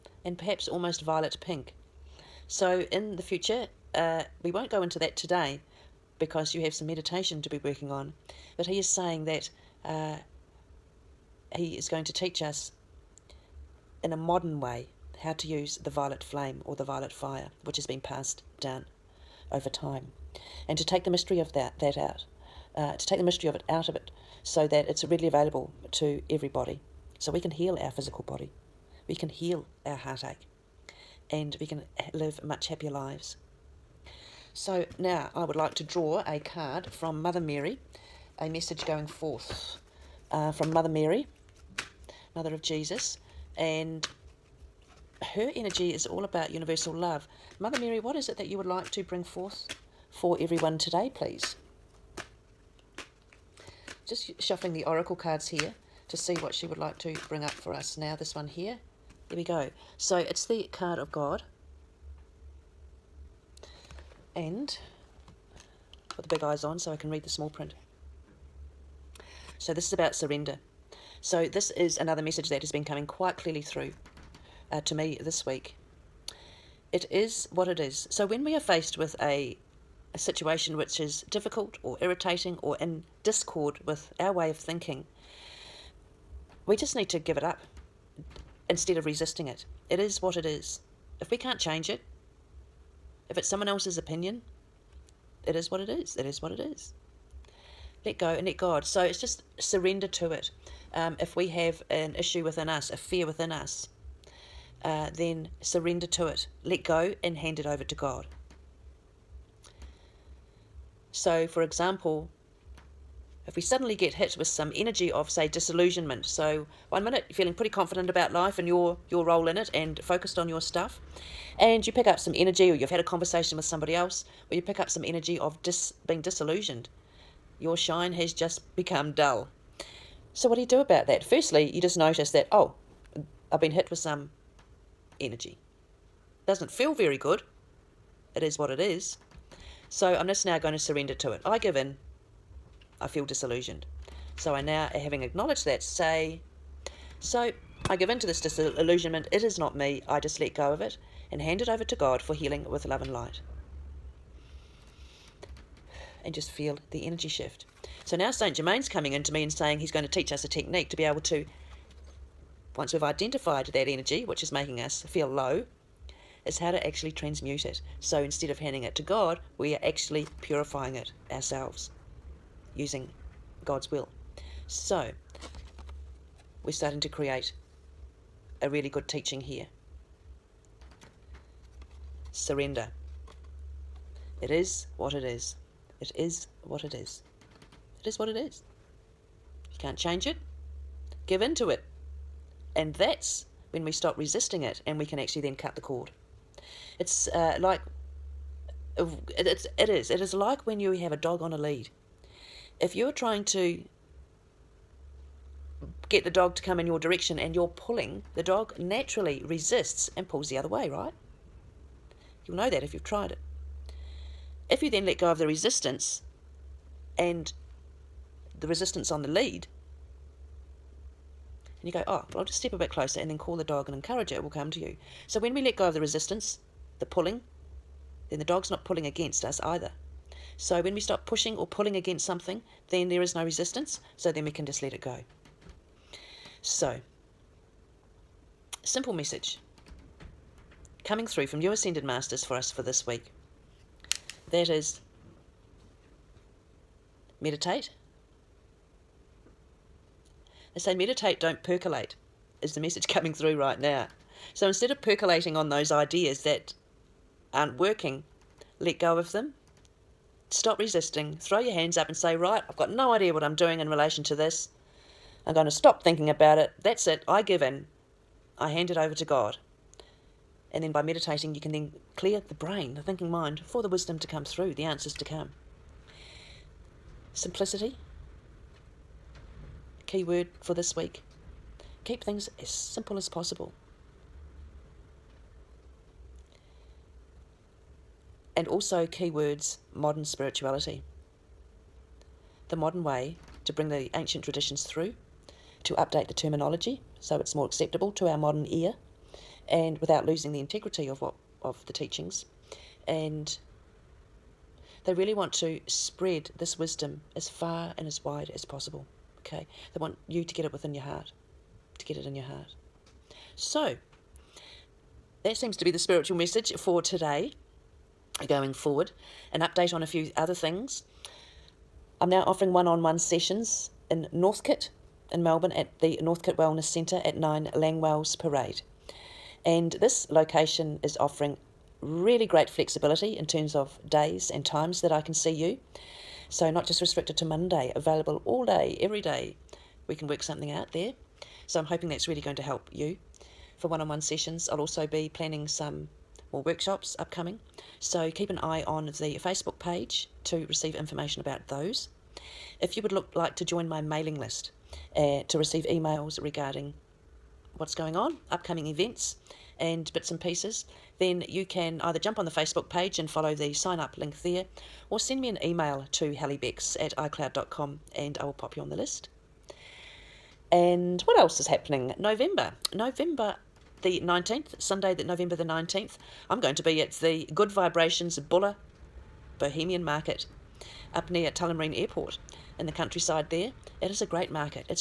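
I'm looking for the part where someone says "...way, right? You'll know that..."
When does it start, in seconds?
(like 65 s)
210 s.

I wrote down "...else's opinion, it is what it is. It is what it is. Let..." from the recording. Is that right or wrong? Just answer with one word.
right.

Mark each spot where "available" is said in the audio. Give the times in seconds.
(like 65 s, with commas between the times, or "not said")
25 s, 337 s.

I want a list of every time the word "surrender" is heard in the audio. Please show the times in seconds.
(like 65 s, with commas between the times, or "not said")
70 s, 99 s, 105 s, 140 s, 182 s.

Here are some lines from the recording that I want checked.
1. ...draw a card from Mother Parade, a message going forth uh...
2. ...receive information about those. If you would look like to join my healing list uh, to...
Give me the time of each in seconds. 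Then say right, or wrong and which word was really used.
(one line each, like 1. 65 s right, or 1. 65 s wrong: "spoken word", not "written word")
1. 35 s wrong: "Mary", not "Parade"
2. 350 s wrong: "mailing", not "healing".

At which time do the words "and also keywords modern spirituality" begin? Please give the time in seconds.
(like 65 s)
288 s.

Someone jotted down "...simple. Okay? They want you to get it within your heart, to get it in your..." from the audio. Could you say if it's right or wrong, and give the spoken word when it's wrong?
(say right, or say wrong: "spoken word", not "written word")
wrong: "possible", not "simple".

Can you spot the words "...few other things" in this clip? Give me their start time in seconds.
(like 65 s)
320 s.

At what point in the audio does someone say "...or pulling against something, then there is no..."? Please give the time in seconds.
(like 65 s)
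231 s.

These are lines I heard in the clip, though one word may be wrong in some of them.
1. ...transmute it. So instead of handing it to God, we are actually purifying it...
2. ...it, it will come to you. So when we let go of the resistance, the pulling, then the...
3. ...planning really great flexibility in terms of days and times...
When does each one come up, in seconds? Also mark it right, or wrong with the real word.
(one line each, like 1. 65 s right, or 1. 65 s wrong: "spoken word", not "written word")
1. 167 s right
2. 224 s right
3. 331 s wrong: "offering", not "planning".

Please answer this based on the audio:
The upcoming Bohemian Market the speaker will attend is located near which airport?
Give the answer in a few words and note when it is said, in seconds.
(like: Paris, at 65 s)
Tullamarine Airport, at 381 s.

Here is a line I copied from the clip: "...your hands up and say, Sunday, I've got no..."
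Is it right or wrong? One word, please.
wrong.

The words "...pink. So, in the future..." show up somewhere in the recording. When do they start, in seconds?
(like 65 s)
1 s.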